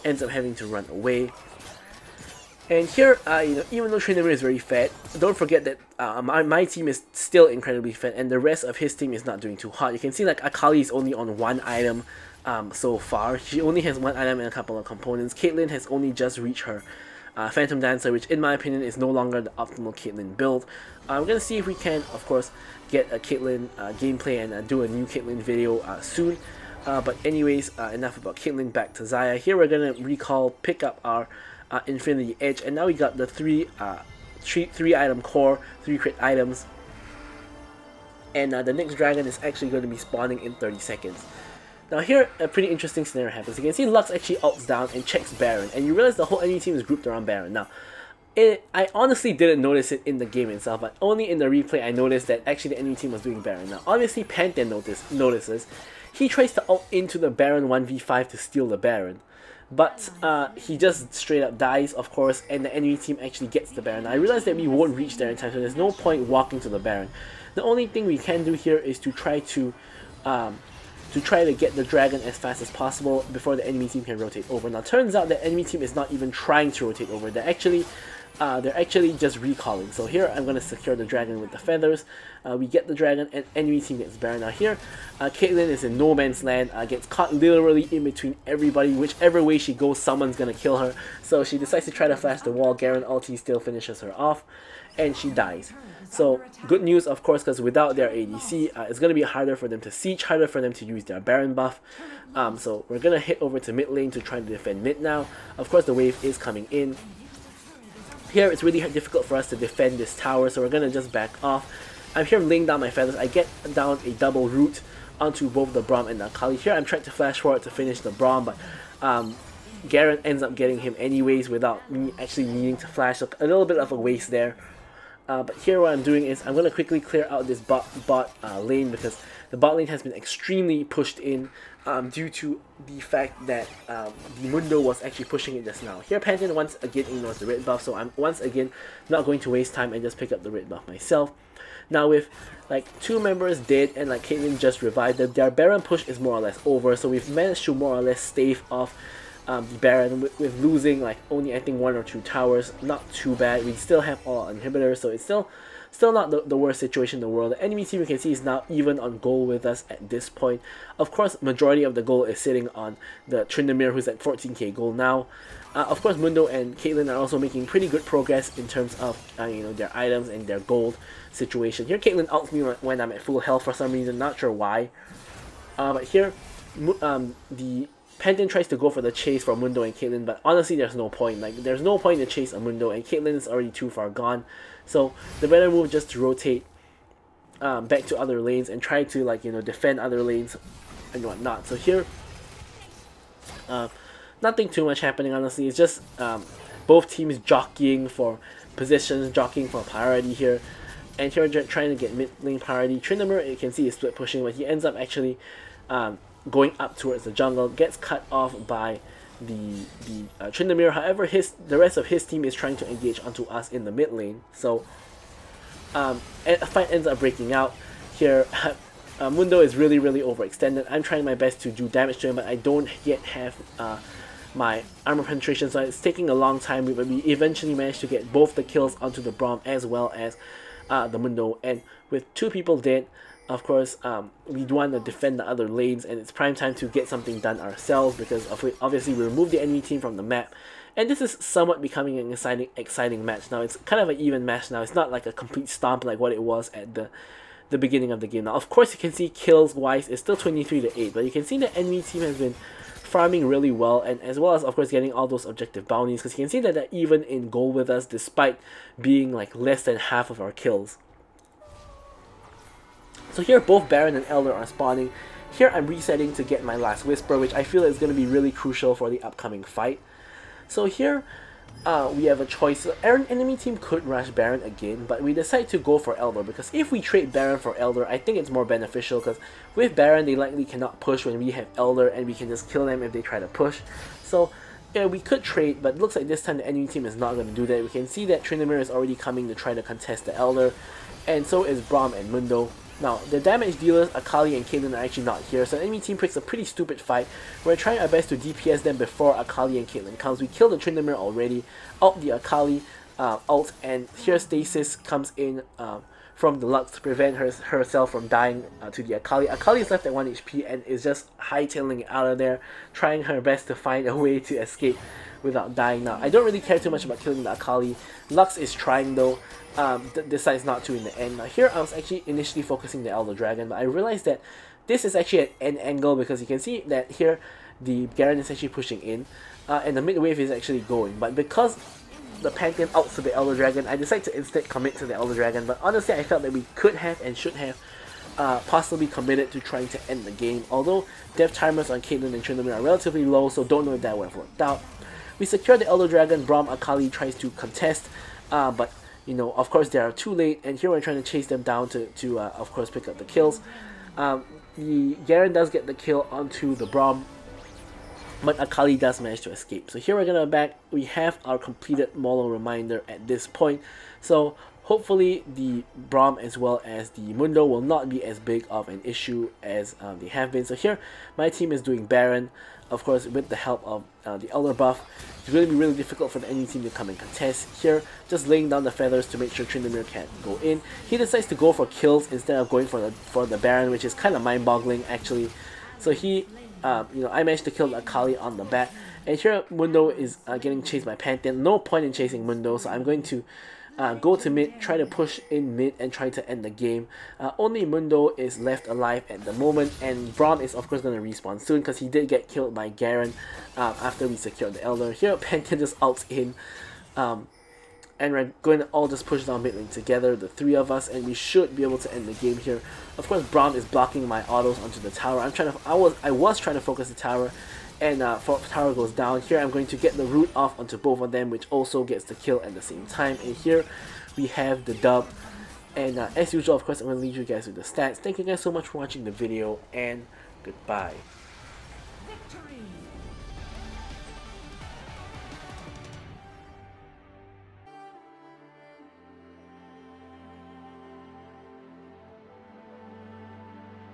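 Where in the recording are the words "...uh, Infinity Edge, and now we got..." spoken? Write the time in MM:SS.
00:31.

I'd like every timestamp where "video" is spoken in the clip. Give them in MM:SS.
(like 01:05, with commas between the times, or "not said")
00:25, 07:09.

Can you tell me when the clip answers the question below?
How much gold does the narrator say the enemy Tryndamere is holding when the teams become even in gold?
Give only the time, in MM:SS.
02:44.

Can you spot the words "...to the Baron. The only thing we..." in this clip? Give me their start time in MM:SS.
01:06.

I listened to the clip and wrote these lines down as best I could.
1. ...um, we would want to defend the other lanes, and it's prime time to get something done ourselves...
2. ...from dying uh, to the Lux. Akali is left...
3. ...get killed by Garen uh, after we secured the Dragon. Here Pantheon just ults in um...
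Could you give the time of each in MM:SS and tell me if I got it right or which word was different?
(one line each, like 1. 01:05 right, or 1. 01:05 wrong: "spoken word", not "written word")
1. 03:54 right
2. 05:08 wrong: "Akali", not "Lux"
3. 06:42 wrong: "Elder", not "Dragon".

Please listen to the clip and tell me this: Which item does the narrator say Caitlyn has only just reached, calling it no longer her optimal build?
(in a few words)
Phantom Dancer.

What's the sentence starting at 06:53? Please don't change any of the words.
Of course, Braum is blocking my autos onto the tower.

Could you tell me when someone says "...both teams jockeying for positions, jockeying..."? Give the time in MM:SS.
03:16.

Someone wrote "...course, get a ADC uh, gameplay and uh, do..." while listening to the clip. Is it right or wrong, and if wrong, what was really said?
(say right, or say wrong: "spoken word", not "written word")
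wrong: "Caitlyn", not "ADC".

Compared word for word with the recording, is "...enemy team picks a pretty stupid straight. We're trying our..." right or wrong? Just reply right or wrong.
wrong.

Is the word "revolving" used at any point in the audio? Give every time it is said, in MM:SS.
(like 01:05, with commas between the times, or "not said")
not said.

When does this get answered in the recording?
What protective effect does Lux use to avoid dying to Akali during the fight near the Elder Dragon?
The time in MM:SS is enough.
05:04.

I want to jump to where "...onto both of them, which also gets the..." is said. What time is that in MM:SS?
07:00.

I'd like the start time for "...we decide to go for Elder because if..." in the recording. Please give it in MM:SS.
04:35.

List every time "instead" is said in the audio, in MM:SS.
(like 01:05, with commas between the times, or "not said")
05:34, 06:22.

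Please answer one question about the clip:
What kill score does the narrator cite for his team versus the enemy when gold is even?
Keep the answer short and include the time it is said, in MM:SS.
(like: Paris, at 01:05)
23 to 8, at 04:10.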